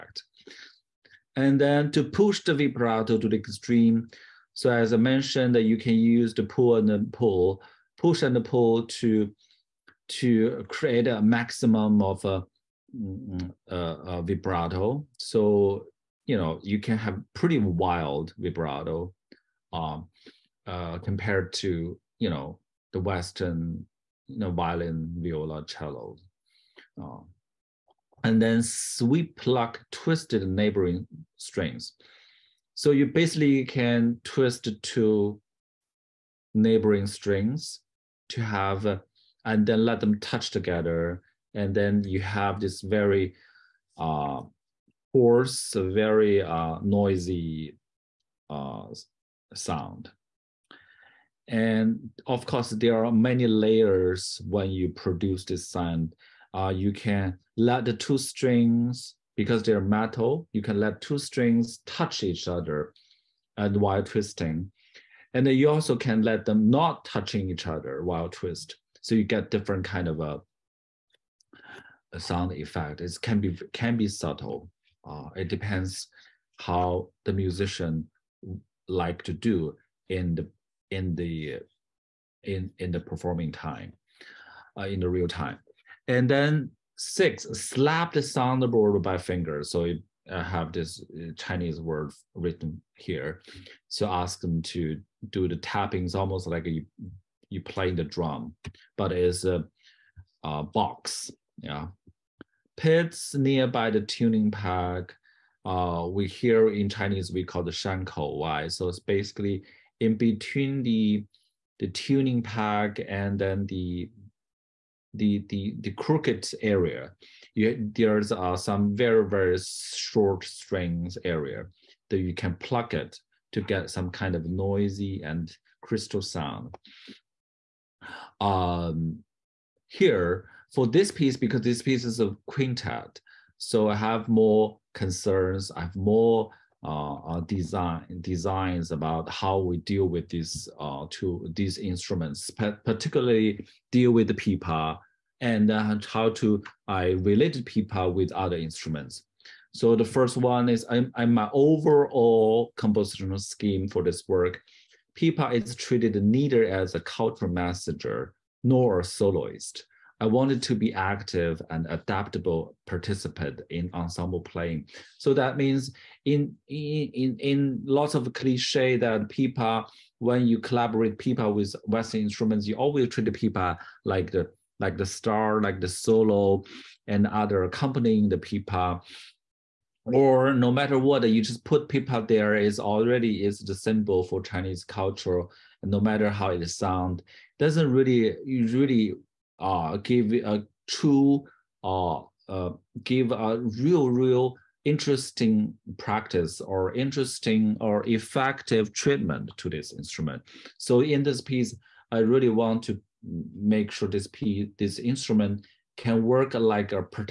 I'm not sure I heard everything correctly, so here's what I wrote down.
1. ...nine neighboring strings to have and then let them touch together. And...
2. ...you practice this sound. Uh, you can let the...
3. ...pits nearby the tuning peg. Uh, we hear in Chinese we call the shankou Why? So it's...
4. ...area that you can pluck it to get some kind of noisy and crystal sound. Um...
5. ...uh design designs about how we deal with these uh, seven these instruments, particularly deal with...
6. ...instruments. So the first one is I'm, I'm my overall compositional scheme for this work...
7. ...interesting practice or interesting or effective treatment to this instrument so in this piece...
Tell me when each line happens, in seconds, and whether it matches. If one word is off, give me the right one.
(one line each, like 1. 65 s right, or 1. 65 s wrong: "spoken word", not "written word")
1. 34 s wrong: "two", not "nine"
2. 54 s wrong: "produce", not "practice"
3. 102 s right
4. 121 s right
5. 137 s wrong: "two", not "seven"
6. 148 s right
7. 194 s right.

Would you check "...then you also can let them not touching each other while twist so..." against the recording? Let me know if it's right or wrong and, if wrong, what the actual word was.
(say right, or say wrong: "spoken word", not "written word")
right.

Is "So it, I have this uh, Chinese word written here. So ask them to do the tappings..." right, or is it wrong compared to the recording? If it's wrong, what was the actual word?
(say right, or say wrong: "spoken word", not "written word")
right.